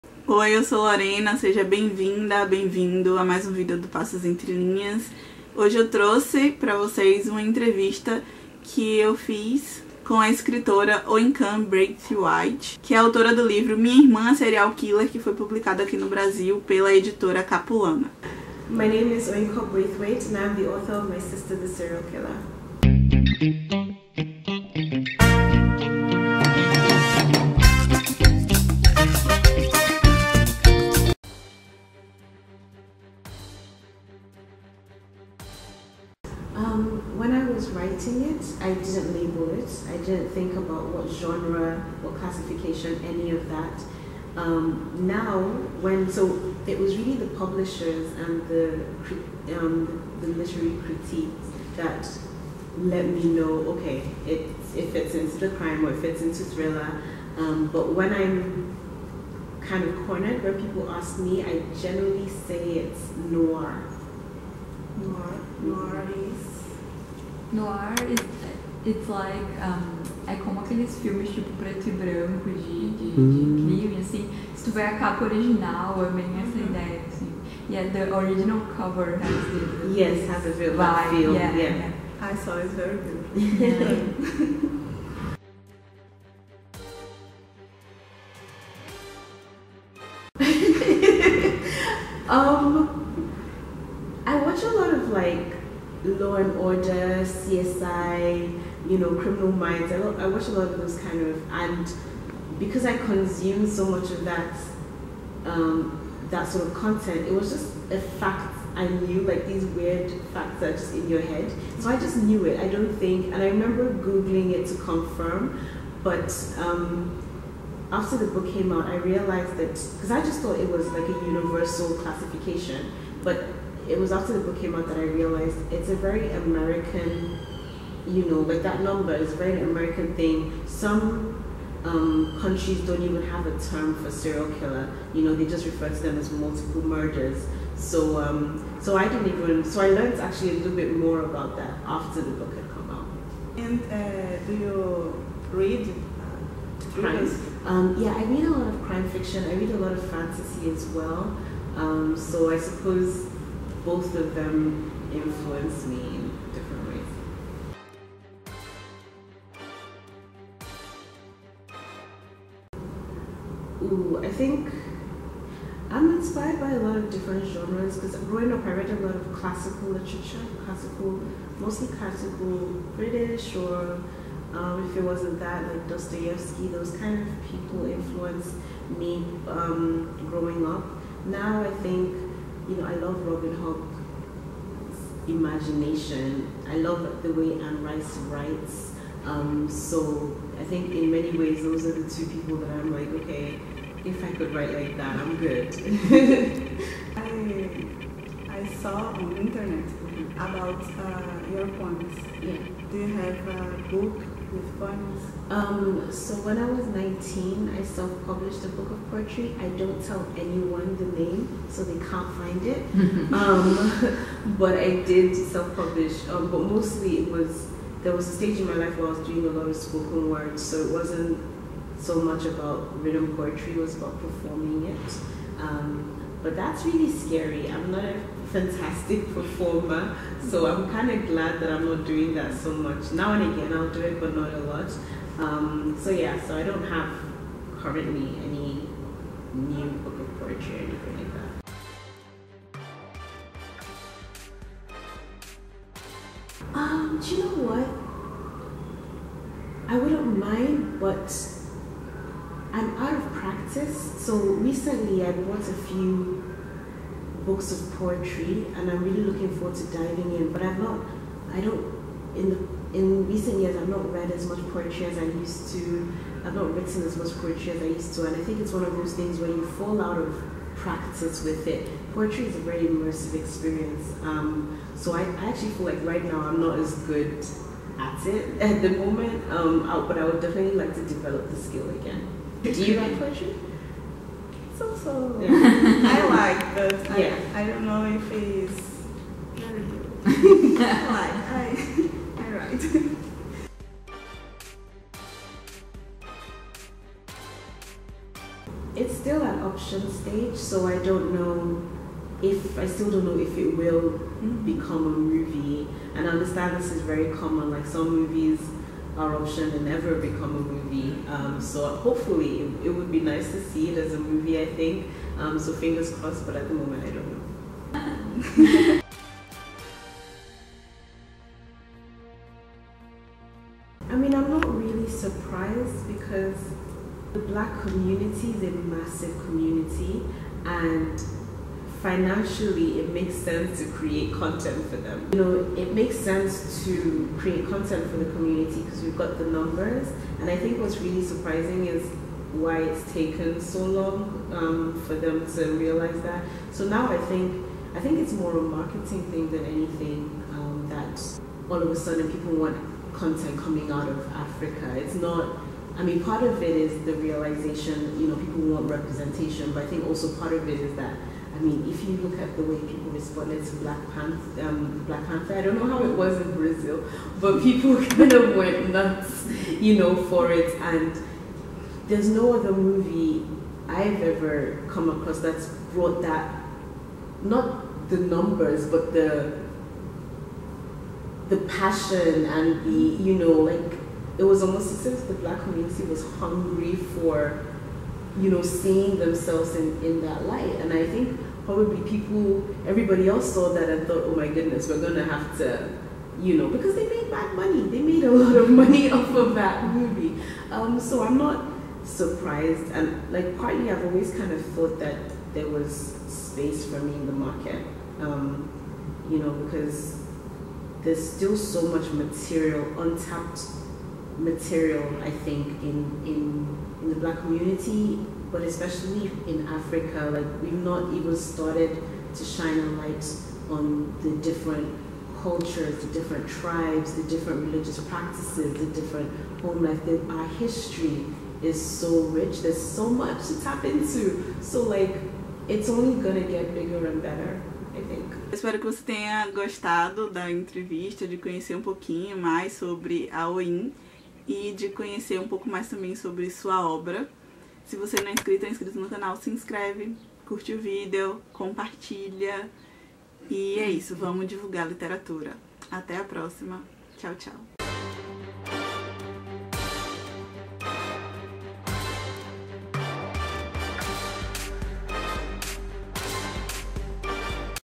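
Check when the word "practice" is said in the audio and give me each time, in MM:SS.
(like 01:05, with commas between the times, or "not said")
04:13, 04:30, 07:08.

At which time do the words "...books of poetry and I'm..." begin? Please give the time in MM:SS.
04:17.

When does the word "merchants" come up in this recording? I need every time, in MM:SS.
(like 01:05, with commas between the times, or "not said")
not said.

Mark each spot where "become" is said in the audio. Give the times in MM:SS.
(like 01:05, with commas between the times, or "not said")
05:04, 05:10.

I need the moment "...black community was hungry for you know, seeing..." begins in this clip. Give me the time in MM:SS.
06:25.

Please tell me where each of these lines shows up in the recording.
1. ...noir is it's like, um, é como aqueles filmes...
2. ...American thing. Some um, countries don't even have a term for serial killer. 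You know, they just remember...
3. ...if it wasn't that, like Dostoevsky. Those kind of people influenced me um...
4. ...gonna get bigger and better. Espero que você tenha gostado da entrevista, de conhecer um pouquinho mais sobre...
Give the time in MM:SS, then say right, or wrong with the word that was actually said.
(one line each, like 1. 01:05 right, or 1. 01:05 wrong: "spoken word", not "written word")
1. 01:07 right
2. 02:09 wrong: "refer", not "remember"
3. 02:54 right
4. 07:16 right.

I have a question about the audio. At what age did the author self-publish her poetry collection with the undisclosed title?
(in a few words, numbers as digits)
19.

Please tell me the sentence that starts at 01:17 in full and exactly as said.
Yeah, the original cover has the, the yes, has a real vibe.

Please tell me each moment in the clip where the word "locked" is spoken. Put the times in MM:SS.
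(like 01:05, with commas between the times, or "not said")
not said.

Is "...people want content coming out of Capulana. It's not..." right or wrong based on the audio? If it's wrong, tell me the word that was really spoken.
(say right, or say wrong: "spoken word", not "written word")
wrong: "Africa", not "Capulana".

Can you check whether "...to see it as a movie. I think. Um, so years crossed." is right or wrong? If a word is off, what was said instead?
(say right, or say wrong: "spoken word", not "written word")
wrong: "fingers", not "years".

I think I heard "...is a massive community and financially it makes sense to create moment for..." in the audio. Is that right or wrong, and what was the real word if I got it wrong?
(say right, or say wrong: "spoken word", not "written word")
wrong: "content", not "moment".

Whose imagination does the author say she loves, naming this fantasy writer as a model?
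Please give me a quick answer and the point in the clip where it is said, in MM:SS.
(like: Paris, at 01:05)
Robin Hobb, at 03:03.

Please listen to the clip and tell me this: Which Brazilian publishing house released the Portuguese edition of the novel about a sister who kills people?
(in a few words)
Capulana.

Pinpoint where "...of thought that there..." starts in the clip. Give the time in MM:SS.
06:44.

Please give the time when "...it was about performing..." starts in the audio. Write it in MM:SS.
03:43.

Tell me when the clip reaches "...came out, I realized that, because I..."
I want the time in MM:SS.
01:58.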